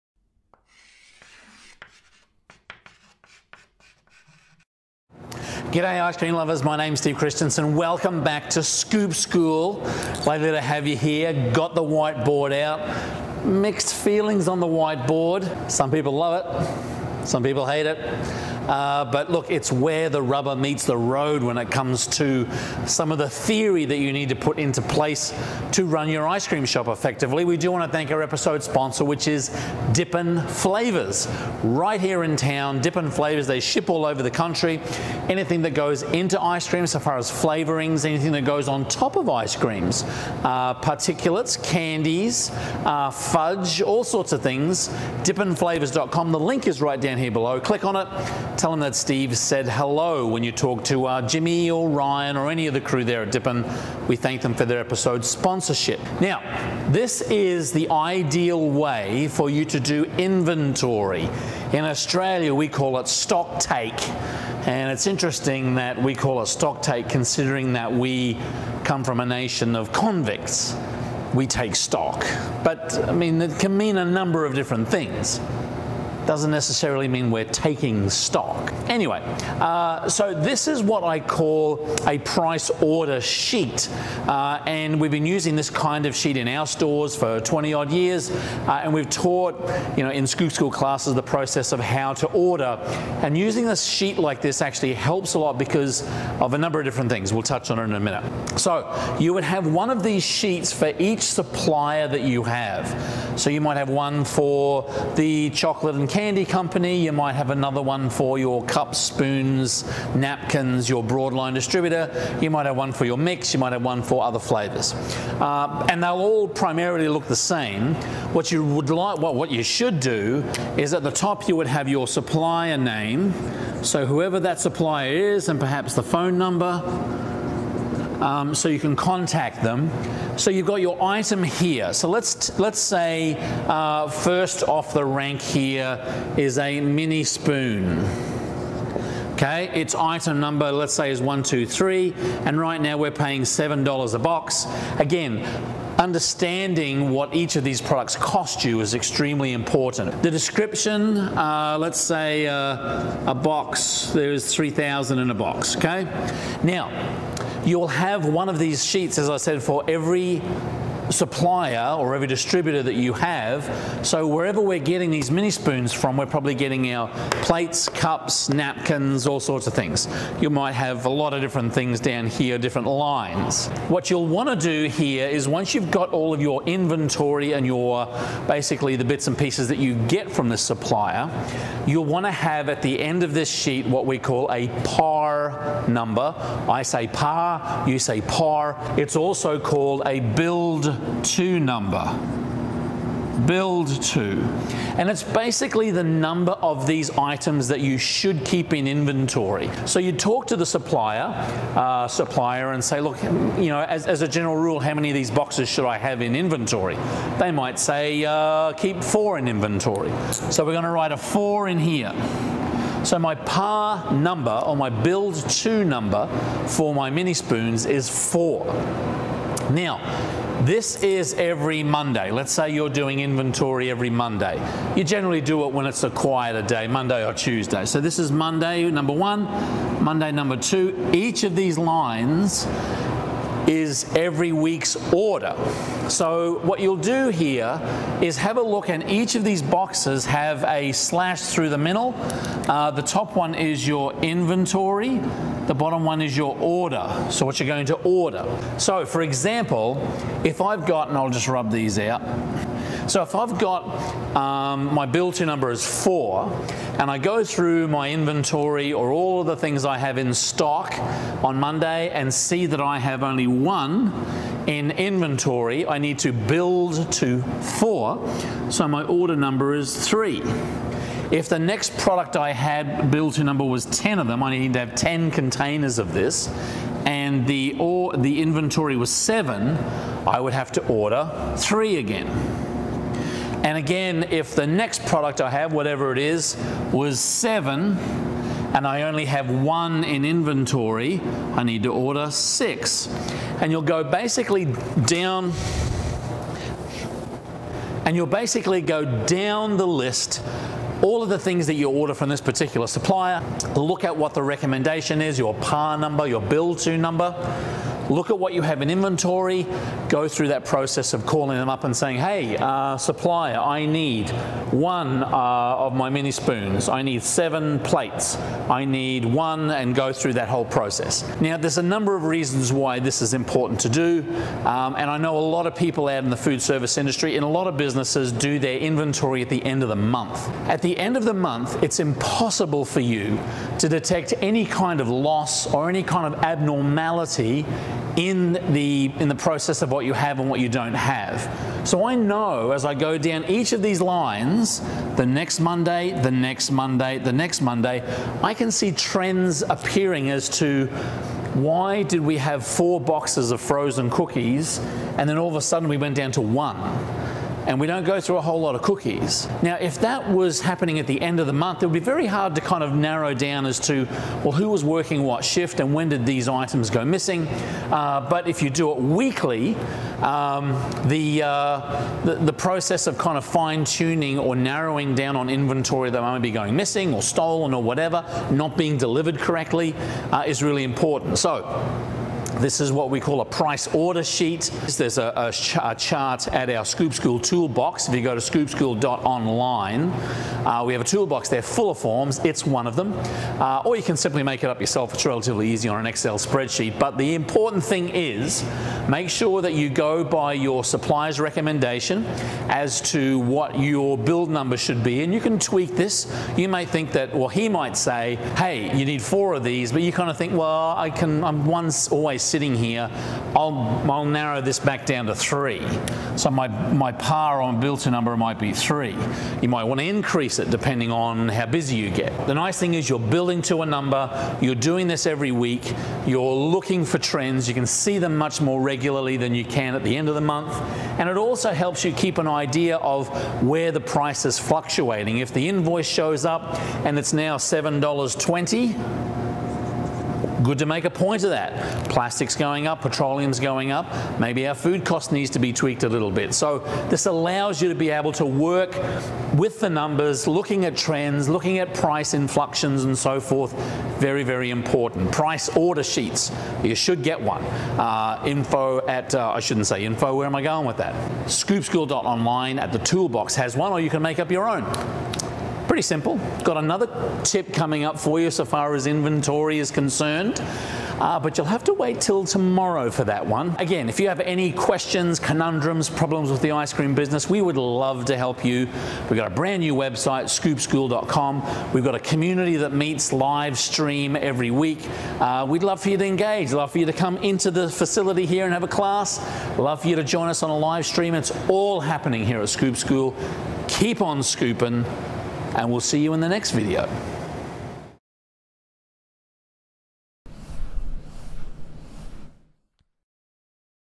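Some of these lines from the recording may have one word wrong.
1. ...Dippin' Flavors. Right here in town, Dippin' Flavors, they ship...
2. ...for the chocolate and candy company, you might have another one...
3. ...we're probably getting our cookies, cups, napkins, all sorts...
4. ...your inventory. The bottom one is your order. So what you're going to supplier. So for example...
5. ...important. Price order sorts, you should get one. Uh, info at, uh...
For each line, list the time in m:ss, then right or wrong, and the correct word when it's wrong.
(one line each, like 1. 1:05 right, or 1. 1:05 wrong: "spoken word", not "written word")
1. 0:29 right
2. 1:44 right
3. 2:46 wrong: "plates", not "cookies"
4. 4:03 wrong: "order", not "supplier"
5. 7:34 wrong: "sheets", not "sorts".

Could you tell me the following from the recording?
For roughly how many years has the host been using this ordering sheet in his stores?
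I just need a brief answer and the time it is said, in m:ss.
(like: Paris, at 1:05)
20, at 1:27.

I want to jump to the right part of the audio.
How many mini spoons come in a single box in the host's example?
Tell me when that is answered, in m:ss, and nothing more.
2:34.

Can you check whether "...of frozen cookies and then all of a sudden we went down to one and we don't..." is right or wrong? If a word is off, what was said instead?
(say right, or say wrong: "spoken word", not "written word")
right.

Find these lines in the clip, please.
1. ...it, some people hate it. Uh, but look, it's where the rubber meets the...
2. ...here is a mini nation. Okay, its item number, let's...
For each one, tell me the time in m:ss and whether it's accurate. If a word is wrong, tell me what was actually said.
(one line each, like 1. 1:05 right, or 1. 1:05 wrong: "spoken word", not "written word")
1. 0:16 right
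2. 2:15 wrong: "spoon", not "nation".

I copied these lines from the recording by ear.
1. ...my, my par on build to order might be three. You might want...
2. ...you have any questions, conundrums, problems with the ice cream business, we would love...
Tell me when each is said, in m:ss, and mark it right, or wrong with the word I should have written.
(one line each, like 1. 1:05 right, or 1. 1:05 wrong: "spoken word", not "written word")
1. 6:56 wrong: "number", not "order"
2. 7:54 right.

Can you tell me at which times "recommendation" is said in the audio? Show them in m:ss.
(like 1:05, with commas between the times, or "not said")
5:04, 6:41.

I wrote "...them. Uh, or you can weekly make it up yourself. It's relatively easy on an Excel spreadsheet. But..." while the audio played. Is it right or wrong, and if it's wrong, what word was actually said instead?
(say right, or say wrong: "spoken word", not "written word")
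wrong: "simply", not "weekly".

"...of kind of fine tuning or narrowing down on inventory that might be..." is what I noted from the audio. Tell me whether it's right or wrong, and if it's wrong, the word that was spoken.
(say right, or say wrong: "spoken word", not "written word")
right.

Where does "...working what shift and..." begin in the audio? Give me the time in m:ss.
6:04.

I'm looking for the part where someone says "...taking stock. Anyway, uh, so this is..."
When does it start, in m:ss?
1:17.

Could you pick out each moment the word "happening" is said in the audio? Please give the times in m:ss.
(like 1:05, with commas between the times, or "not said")
6:00, 8:11.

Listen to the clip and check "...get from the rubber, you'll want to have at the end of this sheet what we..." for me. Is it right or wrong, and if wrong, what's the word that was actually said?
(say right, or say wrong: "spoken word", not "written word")
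wrong: "supplier", not "rubber".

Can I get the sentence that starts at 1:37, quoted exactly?
We'll touch on it in a minute.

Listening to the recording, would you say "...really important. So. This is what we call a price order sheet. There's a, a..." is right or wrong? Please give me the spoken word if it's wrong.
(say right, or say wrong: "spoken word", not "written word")
right.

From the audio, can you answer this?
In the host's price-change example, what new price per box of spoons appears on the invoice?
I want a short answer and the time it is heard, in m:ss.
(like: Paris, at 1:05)
$7.20, at 7:17.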